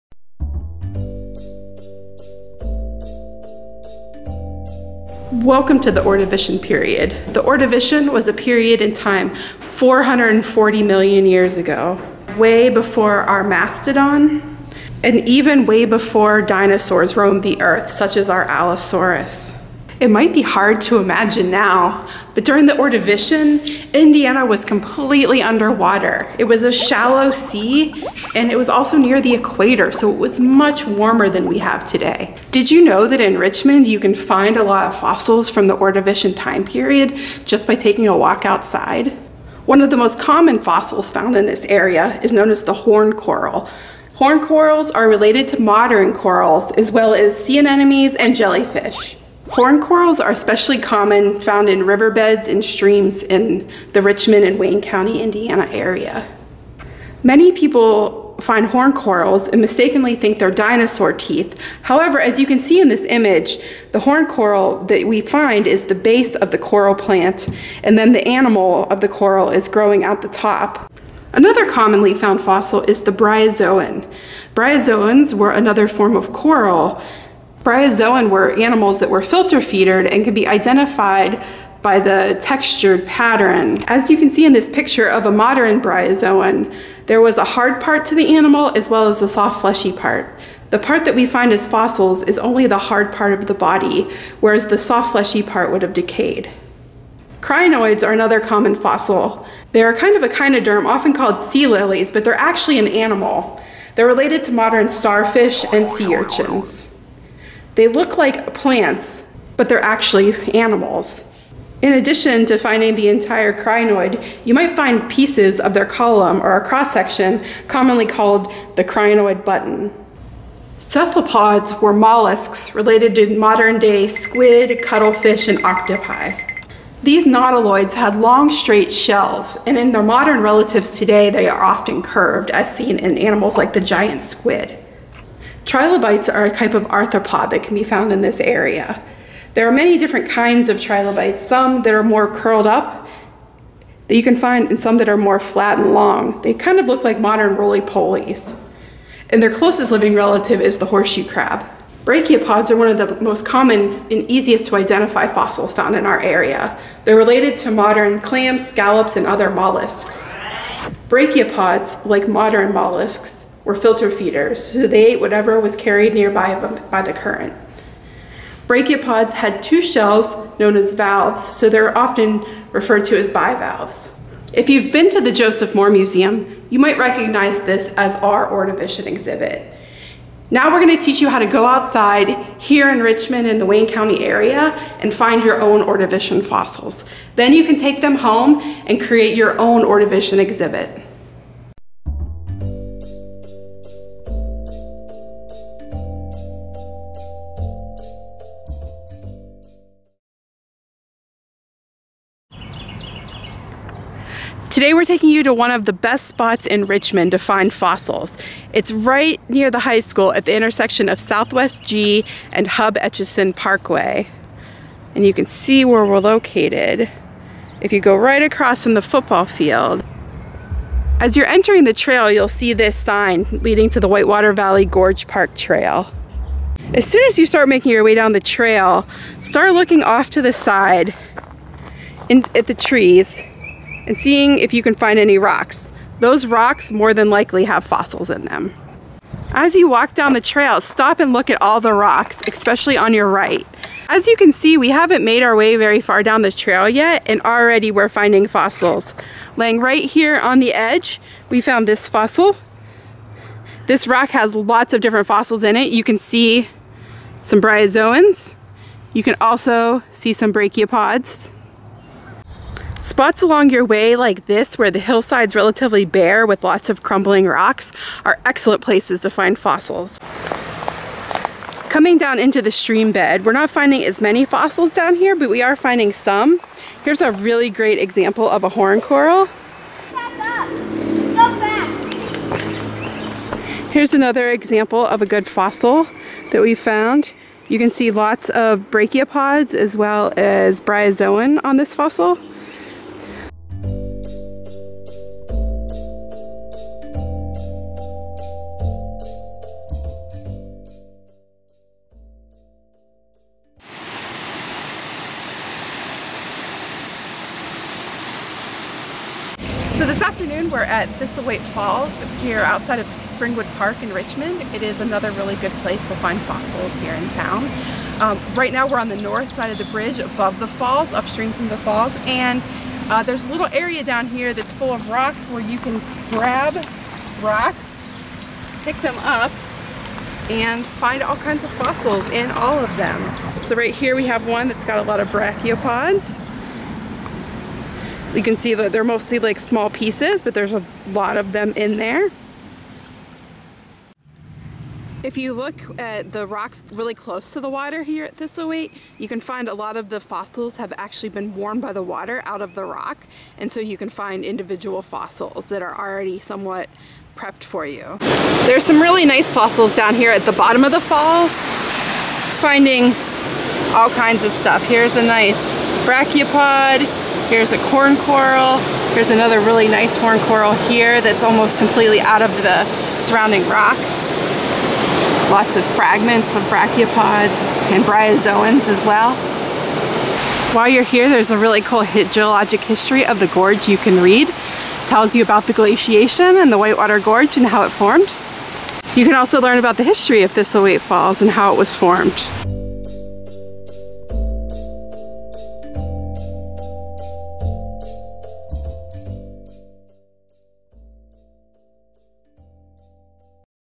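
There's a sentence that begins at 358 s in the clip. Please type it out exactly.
There's some really nice fossils down here at the bottom of the falls, finding all kinds of stuff.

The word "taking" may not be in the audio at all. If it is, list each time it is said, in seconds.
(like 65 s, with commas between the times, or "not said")
37 s, 205 s.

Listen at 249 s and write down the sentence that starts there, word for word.
Laying right here on the edge, we found this fossil.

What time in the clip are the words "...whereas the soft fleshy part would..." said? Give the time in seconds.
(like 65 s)
94 s.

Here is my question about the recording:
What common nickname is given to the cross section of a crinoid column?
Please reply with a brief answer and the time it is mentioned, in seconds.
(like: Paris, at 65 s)
Crinoid button, at 118 s.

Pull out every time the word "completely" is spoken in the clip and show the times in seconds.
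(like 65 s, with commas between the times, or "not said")
24 s, 371 s.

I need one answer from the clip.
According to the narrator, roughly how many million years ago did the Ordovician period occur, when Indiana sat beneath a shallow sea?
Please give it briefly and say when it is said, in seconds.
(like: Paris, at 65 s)
440 million years, at 9 s.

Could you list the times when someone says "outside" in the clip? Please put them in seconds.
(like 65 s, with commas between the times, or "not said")
38 s, 181 s, 312 s.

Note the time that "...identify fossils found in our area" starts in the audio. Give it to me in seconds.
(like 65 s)
154 s.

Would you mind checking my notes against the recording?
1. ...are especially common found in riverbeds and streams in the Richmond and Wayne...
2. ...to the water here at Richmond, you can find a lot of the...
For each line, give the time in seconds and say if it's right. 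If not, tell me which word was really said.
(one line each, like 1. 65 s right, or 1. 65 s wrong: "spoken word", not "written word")
1. 50 s right
2. 347 s wrong: "Thistlethwaite", not "Richmond".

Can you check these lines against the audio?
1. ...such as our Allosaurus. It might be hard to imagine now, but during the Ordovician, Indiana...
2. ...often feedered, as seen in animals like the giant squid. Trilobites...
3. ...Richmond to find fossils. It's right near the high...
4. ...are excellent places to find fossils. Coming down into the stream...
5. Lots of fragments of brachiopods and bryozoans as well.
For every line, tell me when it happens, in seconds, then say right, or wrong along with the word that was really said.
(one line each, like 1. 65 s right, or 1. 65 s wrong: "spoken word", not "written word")
1. 17 s right
2. 131 s wrong: "curved", not "feedered"
3. 206 s right
4. 268 s right
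5. 375 s right.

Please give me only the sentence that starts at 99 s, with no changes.
They are kind of a echinoderm, often called sea lilies, but they're actually an animal.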